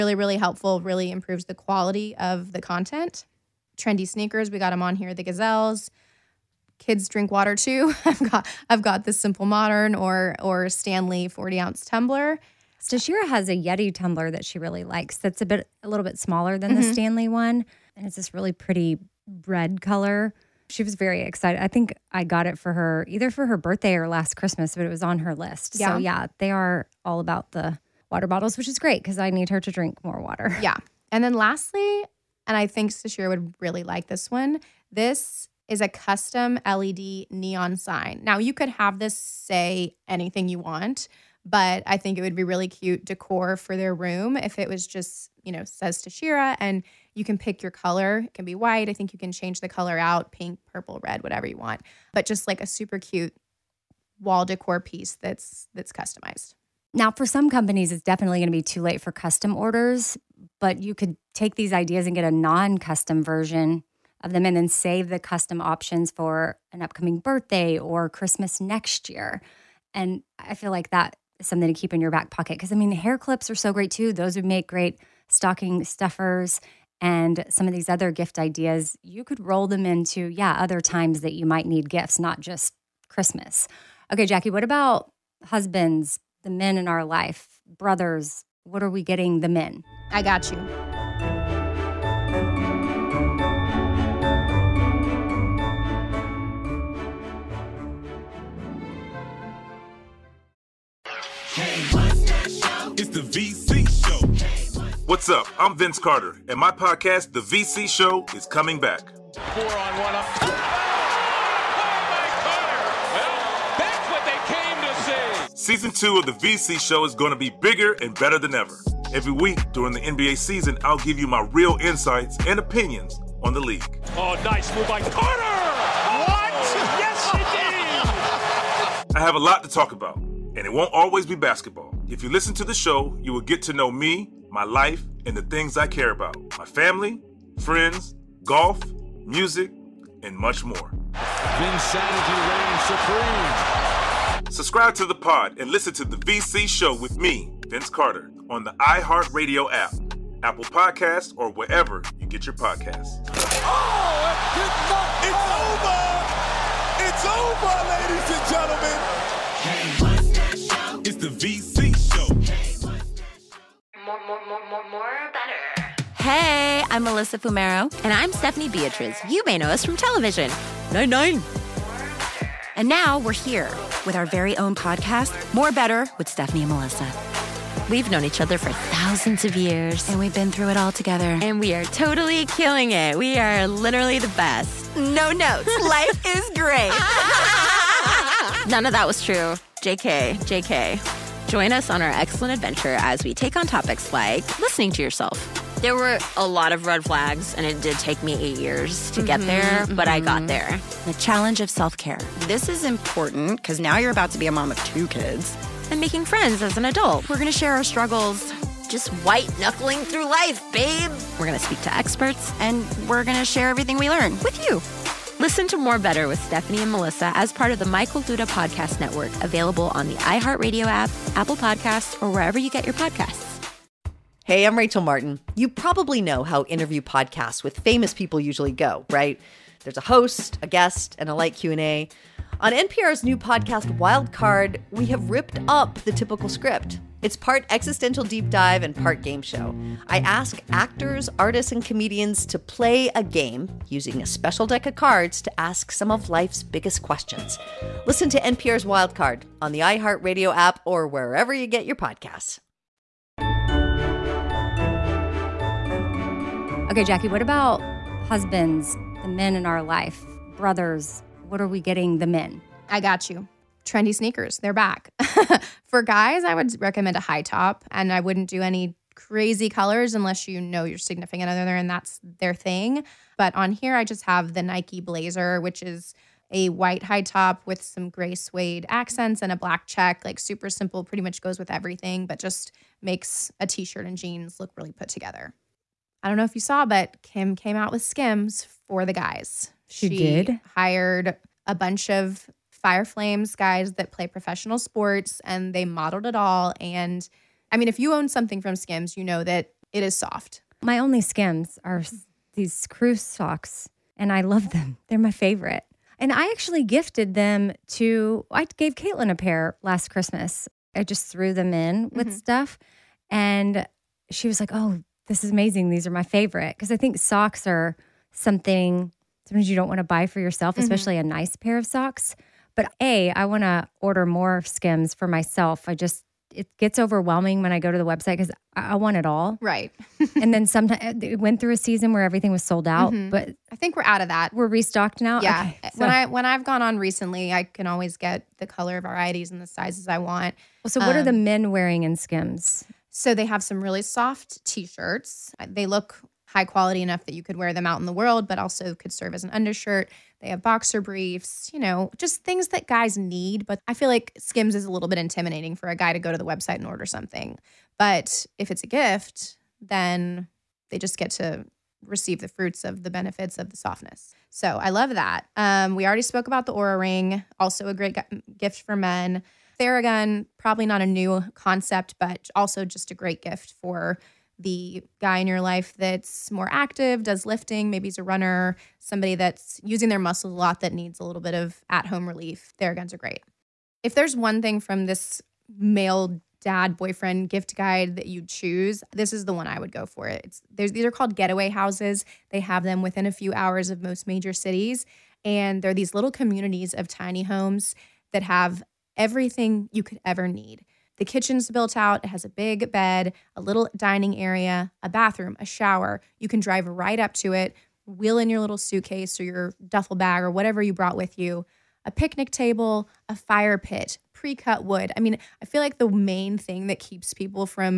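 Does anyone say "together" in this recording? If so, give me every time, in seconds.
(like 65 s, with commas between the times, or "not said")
180 s, 285 s.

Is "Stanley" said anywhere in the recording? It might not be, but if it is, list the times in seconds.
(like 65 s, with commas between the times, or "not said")
10 s, 16 s.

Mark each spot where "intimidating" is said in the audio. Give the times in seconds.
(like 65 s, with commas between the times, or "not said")
355 s.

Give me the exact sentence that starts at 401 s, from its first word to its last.
The kitchen's built out, it has a big bed, a little dining area, a bathroom, a shower.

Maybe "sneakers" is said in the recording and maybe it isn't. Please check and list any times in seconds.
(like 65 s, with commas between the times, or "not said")
4 s, 264 s.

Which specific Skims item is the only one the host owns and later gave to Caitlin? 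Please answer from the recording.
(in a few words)
crew socks.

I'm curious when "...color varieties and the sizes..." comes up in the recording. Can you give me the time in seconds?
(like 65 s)
338 s.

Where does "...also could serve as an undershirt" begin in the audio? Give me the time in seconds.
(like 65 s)
348 s.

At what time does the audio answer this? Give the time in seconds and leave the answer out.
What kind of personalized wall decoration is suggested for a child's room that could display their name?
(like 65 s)
35 s.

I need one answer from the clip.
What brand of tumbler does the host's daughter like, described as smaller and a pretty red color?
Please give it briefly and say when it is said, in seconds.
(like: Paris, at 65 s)
Yeti, at 13 s.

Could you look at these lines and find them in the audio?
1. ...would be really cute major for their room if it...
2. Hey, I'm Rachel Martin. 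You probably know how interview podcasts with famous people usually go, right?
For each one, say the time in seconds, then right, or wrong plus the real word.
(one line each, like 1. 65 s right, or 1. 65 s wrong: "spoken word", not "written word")
1. 42 s wrong: "decor", not "major"
2. 224 s right.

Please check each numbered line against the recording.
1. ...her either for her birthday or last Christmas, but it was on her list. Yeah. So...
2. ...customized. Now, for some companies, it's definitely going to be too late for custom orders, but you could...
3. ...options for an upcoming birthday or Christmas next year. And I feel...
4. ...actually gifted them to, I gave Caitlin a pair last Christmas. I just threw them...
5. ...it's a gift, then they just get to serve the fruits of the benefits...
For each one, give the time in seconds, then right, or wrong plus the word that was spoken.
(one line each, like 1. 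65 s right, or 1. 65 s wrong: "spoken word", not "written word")
1. 22 s right
2. 55 s right
3. 65 s right
4. 306 s right
5. 358 s wrong: "receive", not "serve".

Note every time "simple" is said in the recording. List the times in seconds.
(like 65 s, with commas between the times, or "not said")
9 s, 280 s.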